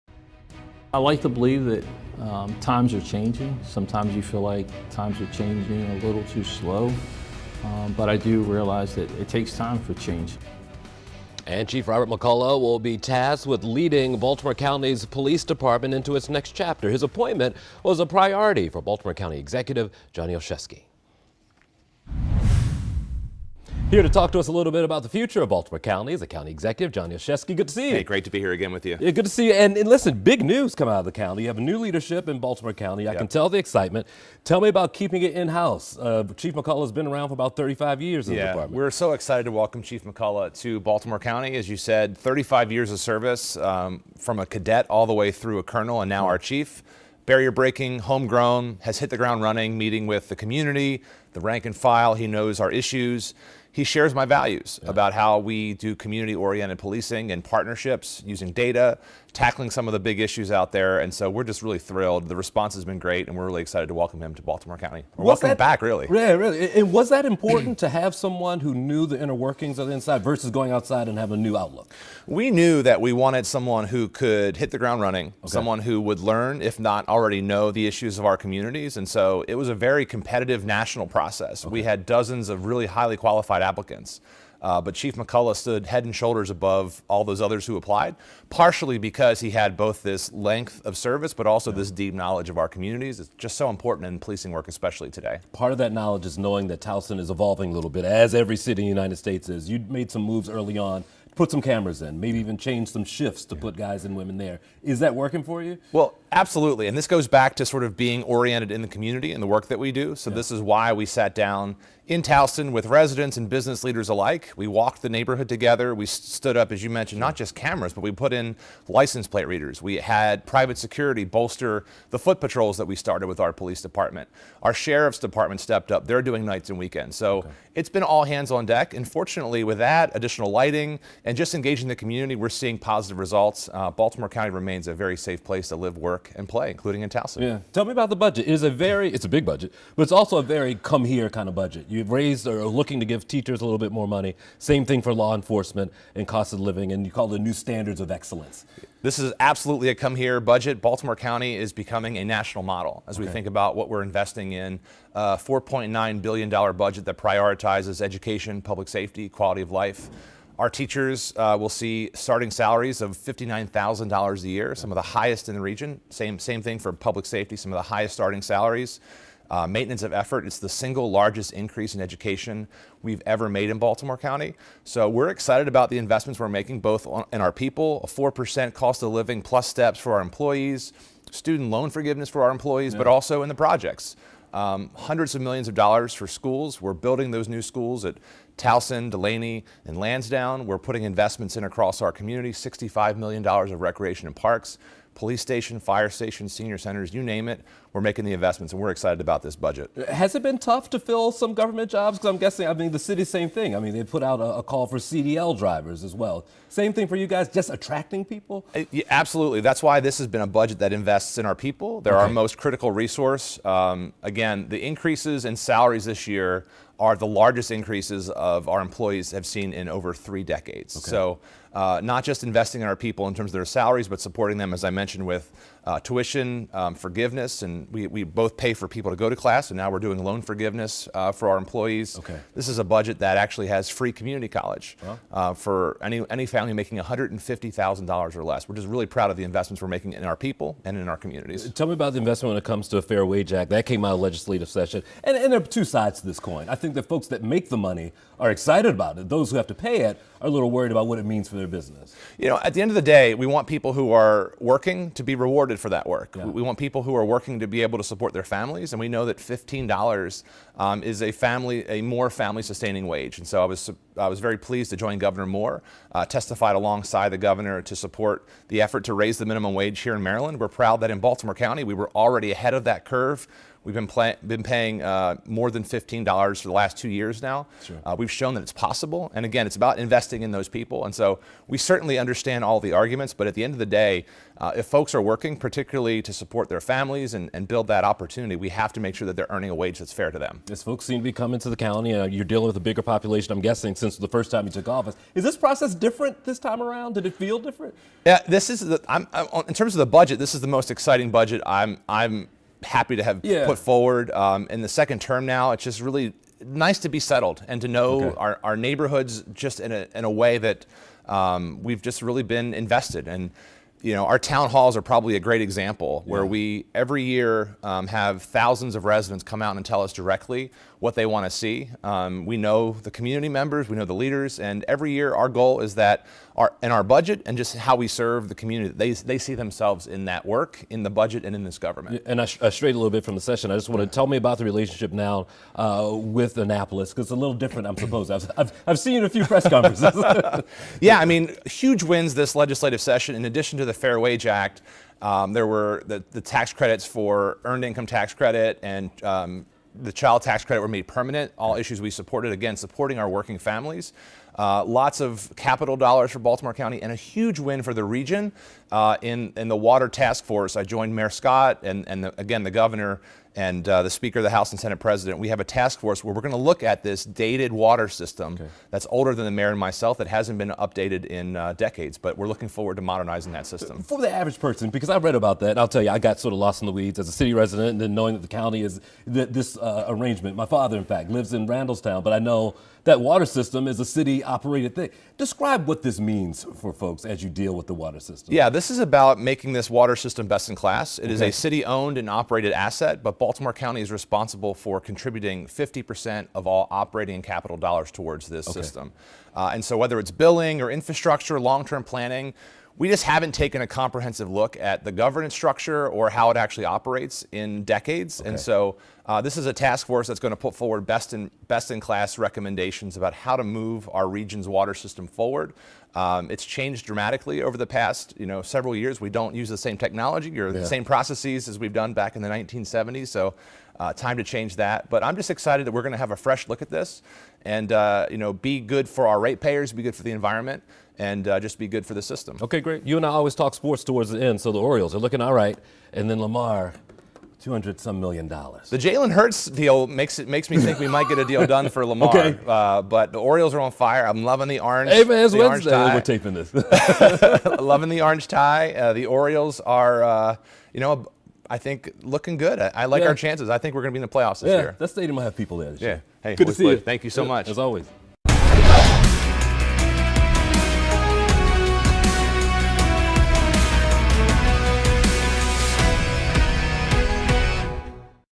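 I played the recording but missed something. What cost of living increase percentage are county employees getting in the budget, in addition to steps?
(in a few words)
4%.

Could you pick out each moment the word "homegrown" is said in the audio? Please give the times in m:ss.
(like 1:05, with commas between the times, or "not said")
0:47.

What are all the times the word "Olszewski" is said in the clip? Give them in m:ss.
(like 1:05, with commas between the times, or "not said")
0:20, 0:27.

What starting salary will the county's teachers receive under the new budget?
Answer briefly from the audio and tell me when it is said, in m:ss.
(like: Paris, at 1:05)
$59,000, at 2:43.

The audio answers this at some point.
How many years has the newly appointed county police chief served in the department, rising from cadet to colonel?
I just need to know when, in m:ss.
0:42.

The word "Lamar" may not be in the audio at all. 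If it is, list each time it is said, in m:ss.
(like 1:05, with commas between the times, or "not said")
7:16, 7:22.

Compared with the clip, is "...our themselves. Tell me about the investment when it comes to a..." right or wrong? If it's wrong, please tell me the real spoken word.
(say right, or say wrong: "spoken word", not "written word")
wrong: "communities", not "themselves".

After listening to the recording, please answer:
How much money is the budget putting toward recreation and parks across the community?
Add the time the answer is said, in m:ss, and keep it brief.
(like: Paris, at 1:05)
$65 million, at 3:12.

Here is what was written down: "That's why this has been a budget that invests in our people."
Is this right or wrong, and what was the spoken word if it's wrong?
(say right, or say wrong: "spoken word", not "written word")
right.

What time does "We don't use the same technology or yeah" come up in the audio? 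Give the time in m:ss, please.
6:59.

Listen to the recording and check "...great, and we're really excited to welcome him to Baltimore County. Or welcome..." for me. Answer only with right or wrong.
right.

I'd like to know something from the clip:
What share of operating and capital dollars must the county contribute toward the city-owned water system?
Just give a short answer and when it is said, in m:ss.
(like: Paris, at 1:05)
50%, at 6:35.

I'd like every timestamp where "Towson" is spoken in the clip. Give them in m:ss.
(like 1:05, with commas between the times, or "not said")
1:36, 1:52, 2:17, 3:08.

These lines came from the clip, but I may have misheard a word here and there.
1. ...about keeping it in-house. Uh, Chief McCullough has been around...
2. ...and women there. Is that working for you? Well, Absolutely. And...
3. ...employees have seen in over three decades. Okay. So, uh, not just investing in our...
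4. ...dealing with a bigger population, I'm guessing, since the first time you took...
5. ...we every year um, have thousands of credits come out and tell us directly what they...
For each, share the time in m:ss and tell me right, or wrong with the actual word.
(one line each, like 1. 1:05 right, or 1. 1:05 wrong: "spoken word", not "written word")
1. 0:34 right
2. 1:44 right
3. 3:38 right
4. 4:52 right
5. 5:16 wrong: "residents", not "credits".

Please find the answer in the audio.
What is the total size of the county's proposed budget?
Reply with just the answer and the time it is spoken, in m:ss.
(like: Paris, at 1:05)
$4.9 billion, at 2:35.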